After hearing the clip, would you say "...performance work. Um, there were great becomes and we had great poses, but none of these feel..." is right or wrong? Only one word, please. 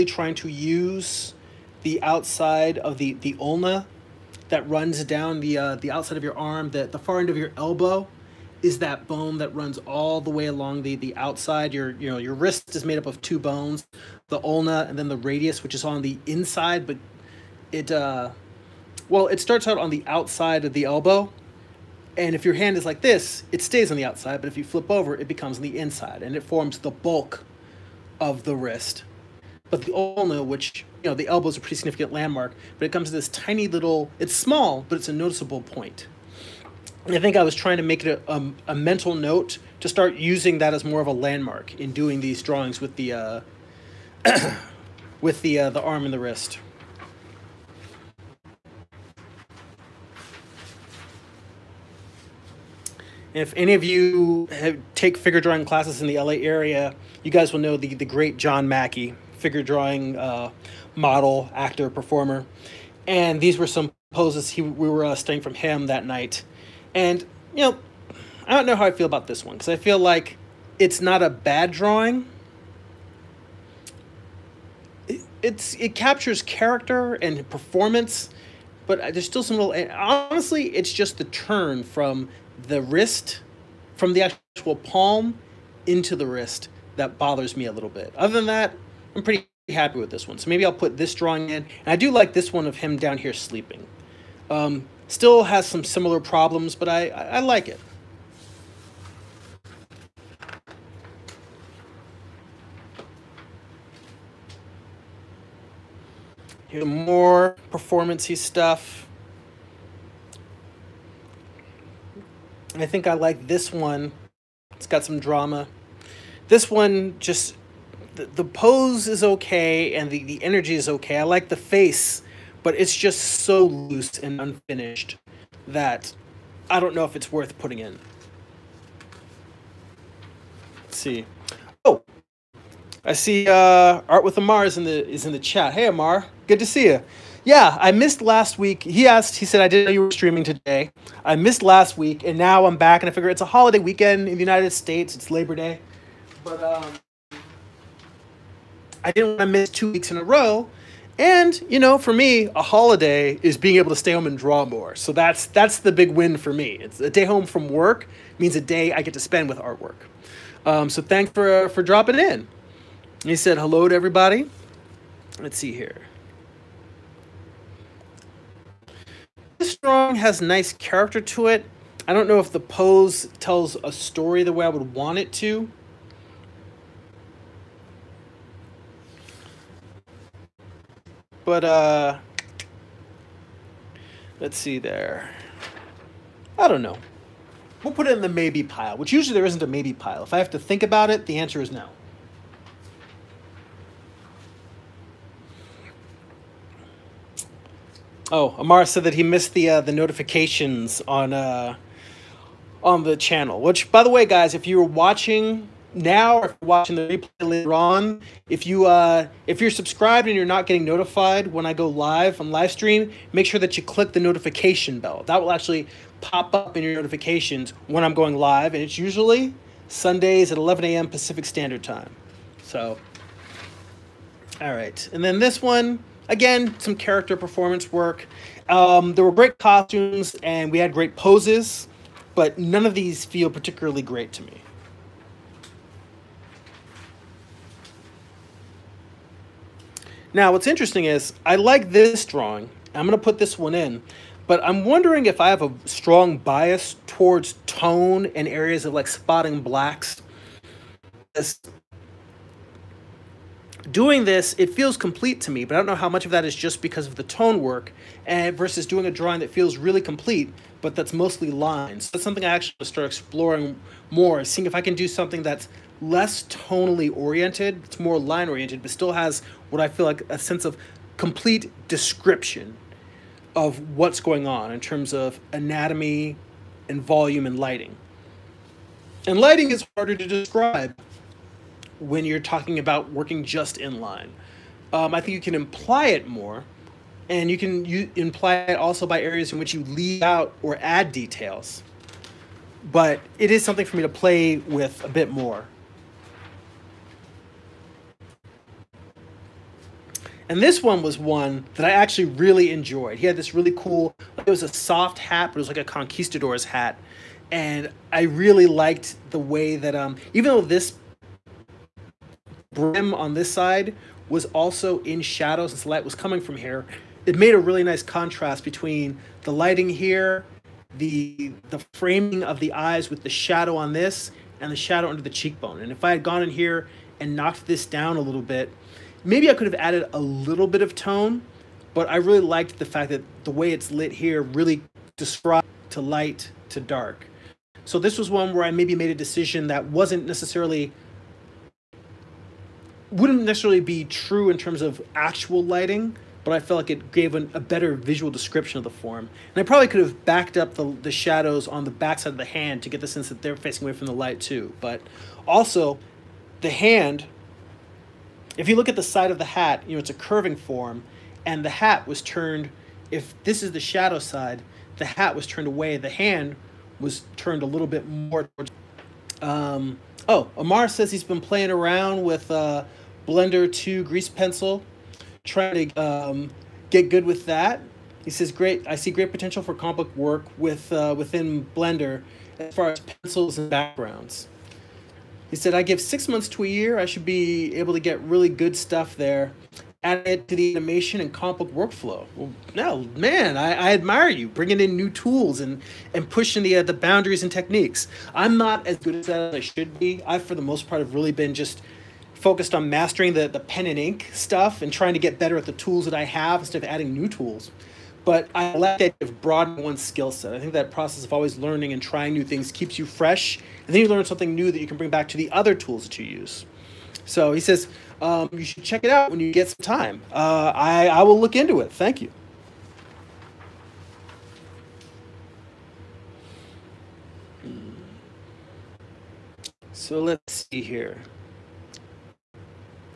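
wrong.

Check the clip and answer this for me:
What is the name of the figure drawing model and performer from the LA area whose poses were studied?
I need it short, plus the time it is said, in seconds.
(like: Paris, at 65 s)
John Mackey, at 58 s.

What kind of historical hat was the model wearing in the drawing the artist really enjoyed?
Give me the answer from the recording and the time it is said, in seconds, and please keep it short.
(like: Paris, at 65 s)
conquistador's hat, at 305 s.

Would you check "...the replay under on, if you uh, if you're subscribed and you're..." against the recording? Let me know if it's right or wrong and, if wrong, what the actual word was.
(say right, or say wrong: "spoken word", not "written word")
wrong: "later", not "under".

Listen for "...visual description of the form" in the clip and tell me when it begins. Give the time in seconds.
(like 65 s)
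347 s.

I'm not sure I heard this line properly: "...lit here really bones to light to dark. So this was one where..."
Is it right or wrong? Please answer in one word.
wrong.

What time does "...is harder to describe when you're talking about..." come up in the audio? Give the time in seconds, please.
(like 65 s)
279 s.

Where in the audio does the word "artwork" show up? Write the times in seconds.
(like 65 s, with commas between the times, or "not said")
159 s.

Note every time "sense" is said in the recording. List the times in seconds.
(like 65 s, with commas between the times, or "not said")
270 s, 353 s.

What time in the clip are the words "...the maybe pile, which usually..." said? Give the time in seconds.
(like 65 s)
188 s.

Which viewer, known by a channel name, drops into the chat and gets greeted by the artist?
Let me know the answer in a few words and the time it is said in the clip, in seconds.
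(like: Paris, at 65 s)
Art with Amar, at 134 s.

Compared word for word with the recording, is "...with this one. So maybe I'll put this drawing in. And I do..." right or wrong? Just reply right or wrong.
right.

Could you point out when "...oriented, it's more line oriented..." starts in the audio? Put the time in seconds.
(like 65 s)
267 s.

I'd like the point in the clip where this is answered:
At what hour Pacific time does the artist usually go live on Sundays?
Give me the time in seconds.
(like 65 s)
220 s.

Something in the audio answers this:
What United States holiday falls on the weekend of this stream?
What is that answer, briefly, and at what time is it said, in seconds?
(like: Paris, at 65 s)
Labor Day, at 145 s.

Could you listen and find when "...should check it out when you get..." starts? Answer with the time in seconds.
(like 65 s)
418 s.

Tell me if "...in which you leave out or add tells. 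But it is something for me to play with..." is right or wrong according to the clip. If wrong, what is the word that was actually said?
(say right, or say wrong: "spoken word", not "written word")
wrong: "details", not "tells".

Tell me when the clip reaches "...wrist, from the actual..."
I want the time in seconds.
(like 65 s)
82 s.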